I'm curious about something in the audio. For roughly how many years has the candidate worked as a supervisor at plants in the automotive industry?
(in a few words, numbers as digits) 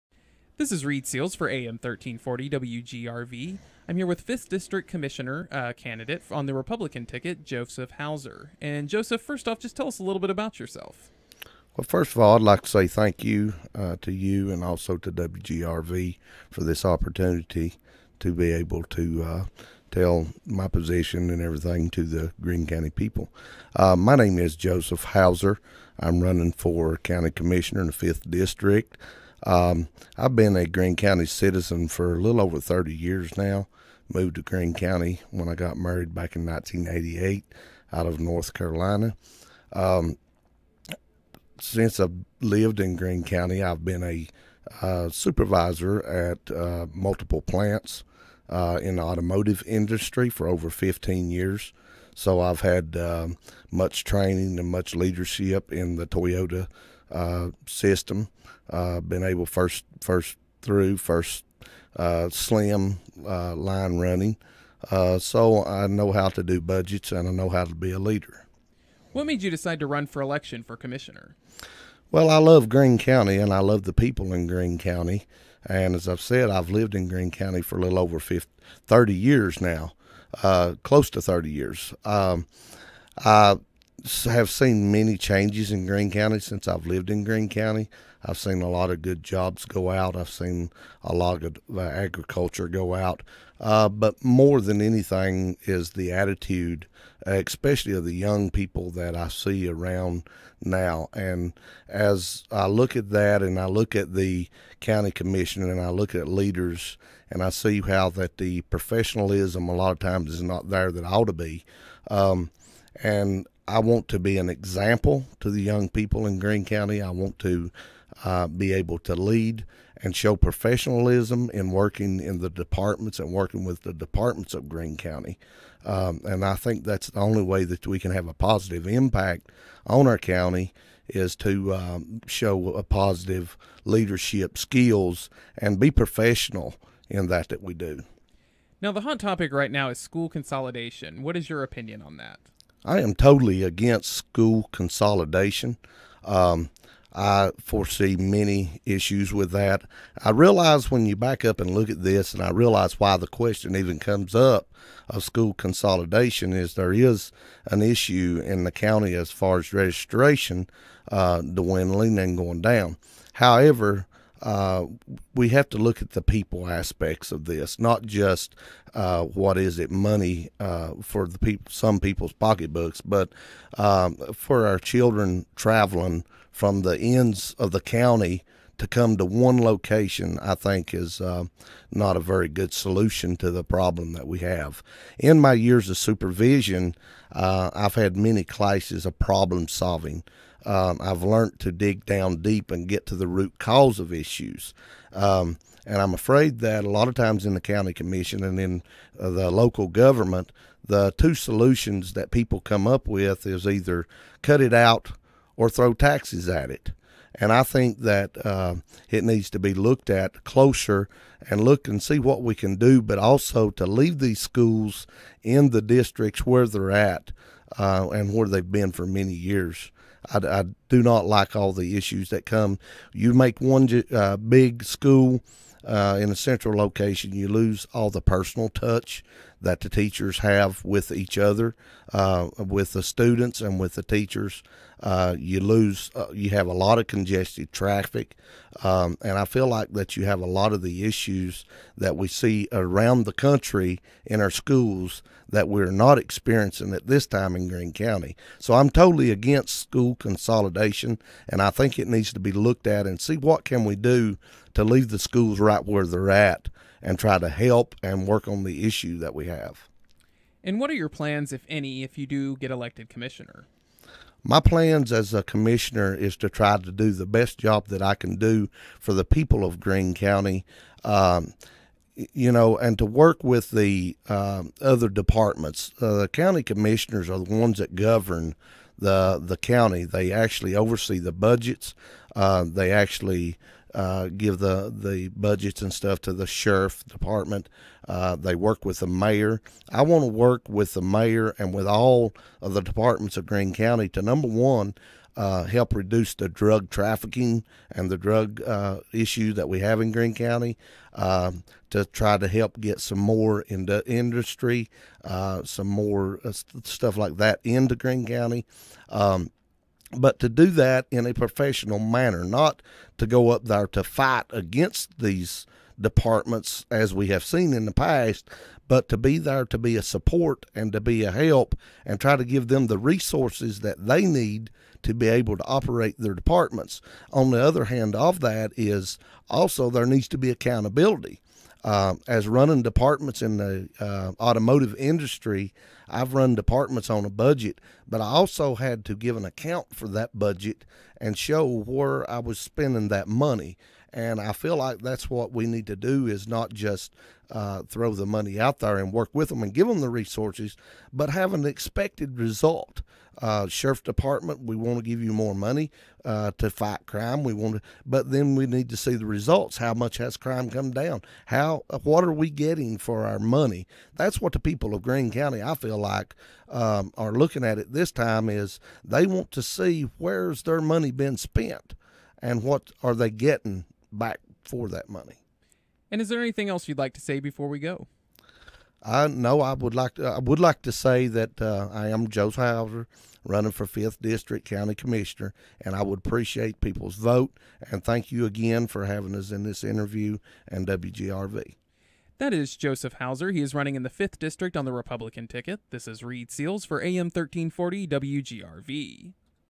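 15 years.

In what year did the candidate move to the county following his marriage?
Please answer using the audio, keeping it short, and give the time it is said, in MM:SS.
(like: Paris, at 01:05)
1988, at 00:36.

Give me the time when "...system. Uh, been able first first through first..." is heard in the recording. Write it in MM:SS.
00:57.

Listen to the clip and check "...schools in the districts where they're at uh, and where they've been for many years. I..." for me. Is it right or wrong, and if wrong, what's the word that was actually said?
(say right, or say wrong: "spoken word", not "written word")
right.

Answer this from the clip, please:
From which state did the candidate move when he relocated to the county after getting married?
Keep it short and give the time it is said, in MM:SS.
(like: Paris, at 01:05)
North Carolina, at 00:38.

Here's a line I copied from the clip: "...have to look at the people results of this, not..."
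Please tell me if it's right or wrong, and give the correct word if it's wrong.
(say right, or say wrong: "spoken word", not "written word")
wrong: "aspects", not "results".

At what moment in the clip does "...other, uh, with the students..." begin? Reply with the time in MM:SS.
03:51.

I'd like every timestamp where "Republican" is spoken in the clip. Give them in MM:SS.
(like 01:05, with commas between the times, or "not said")
00:06, 06:34.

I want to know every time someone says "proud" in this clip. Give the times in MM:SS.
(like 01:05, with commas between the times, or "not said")
not said.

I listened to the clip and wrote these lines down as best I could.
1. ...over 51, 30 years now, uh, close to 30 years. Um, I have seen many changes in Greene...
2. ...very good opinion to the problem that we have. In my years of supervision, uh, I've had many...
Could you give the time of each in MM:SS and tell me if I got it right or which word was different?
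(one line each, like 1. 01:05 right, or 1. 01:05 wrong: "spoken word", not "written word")
1. 01:17 wrong: "50", not "51"
2. 03:02 wrong: "solution", not "opinion".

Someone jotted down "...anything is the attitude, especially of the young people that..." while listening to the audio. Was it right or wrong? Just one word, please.
right.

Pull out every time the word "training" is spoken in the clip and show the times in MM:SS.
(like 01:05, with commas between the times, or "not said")
00:54.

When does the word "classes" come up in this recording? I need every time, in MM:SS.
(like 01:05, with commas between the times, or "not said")
03:08.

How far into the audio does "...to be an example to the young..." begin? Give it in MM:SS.
01:54.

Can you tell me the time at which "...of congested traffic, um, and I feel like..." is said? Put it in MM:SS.
03:56.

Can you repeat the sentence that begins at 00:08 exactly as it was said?
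And Joseph, first off, just tell us a little bit about yourself.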